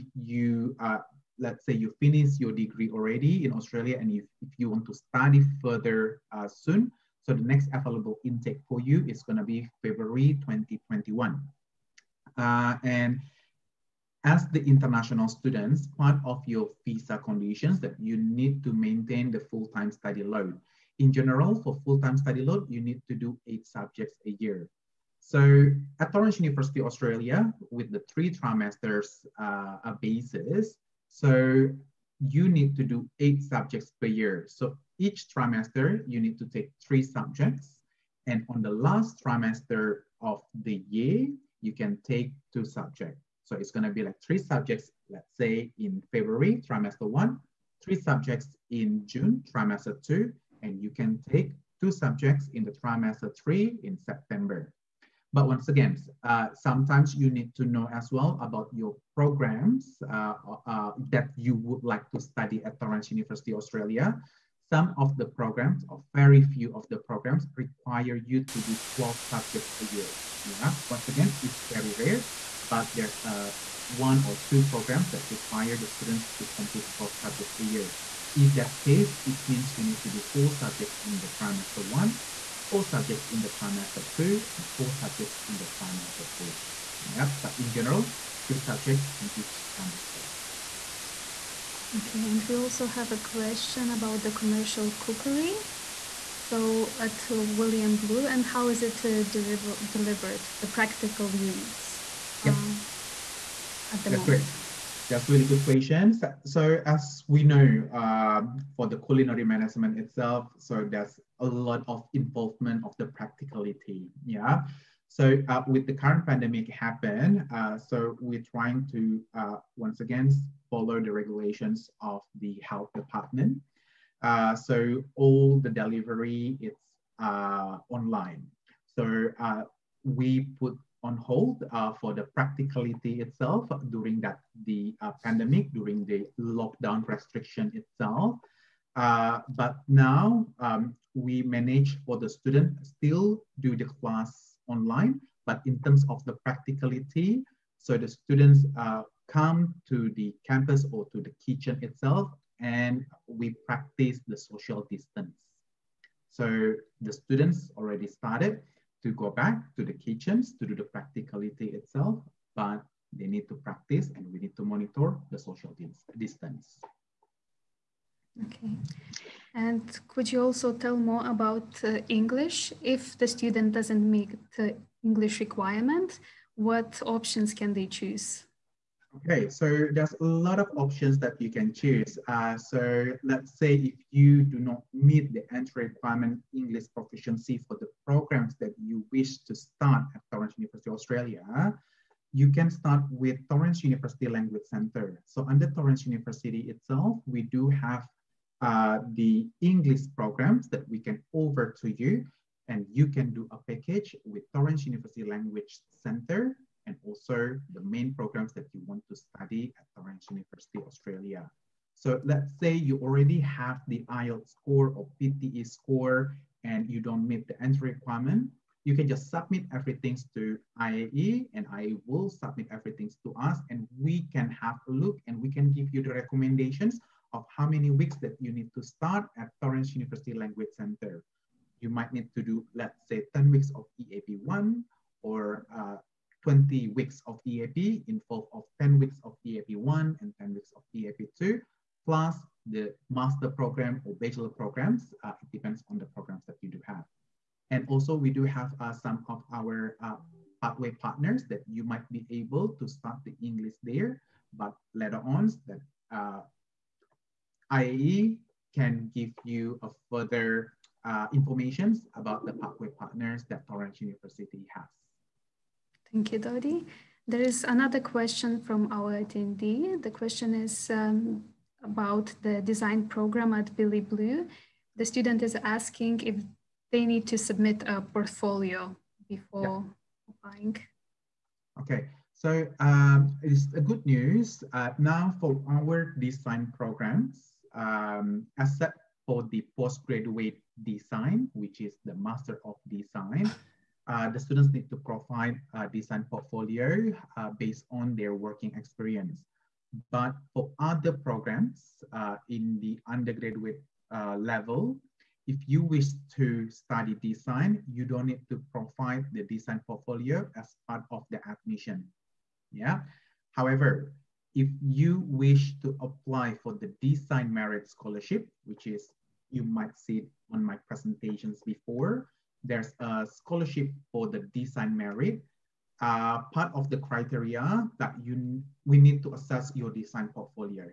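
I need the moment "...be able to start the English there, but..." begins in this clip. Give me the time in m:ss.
4:12.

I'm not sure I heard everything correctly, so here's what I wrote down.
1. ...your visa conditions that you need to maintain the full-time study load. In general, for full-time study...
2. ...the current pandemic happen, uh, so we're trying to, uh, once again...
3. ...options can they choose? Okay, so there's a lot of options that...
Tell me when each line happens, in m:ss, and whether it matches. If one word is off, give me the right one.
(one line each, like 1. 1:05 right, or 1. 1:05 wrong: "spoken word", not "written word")
1. 0:16 right
2. 1:55 right
3. 2:57 right.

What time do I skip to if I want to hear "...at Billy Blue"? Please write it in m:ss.
4:33.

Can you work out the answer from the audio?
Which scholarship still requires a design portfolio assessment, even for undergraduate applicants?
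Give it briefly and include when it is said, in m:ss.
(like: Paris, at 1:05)
design merit scholarship, at 5:17.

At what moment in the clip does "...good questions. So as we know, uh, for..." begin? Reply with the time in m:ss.
1:45.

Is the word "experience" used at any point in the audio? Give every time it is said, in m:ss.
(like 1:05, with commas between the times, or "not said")
4:58.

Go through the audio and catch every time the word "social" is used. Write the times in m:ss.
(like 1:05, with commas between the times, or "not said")
2:34, 2:45.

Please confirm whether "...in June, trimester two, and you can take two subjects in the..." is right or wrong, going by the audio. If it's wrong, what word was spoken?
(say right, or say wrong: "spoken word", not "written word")
right.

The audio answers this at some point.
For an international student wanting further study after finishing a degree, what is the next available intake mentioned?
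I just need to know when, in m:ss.
0:09.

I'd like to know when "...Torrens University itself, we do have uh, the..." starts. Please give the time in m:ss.
3:15.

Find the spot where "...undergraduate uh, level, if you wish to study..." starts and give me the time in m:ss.
5:03.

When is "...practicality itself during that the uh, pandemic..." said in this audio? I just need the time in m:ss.
2:12.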